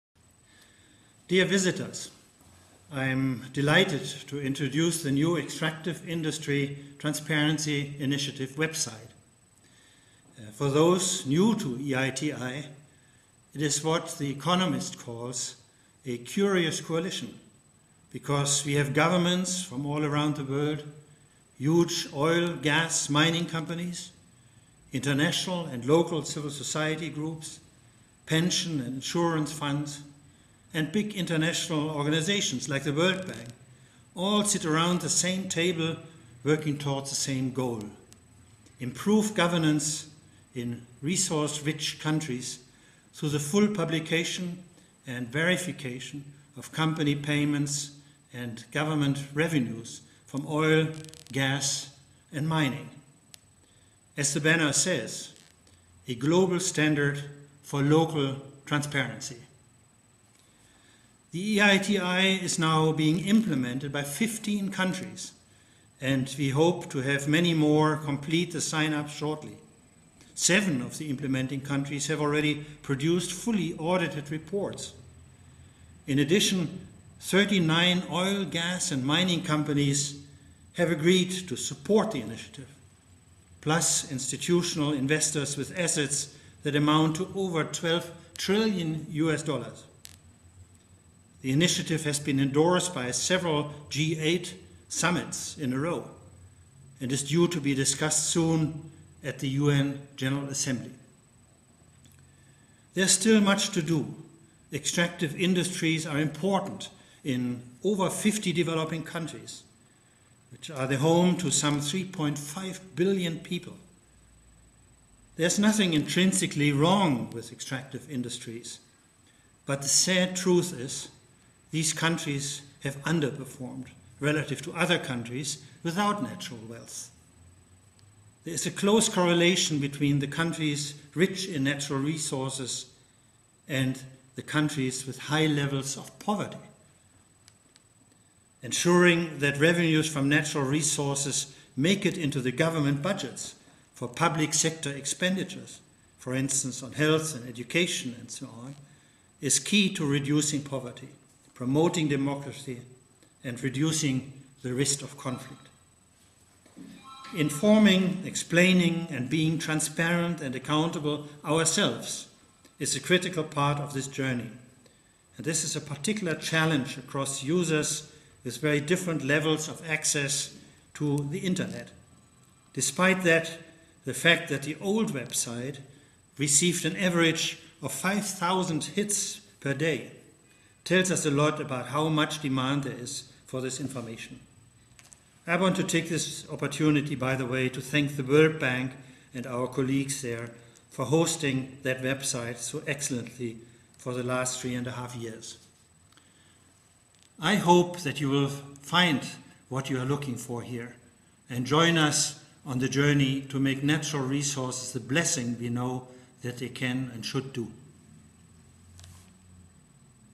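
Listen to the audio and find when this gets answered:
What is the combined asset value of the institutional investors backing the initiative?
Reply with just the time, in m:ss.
1:27.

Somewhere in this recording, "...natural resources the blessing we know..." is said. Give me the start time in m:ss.
3:23.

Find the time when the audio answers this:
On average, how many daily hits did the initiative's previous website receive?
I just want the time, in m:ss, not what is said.
2:57.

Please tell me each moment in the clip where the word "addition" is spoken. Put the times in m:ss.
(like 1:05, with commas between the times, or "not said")
1:16.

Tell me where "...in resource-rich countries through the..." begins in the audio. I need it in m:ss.
0:40.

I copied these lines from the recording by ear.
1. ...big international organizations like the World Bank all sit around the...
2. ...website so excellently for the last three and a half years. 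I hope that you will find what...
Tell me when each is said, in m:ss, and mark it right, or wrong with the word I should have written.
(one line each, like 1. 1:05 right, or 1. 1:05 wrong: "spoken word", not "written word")
1. 0:30 right
2. 3:12 right.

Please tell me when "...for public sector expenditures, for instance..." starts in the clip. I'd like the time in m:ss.
2:23.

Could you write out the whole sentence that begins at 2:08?
There is a close correlation between the countries rich in natural resources and the countries with high levels of poverty.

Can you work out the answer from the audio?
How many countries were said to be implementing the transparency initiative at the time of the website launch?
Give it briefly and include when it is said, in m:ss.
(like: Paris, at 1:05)
15, at 1:04.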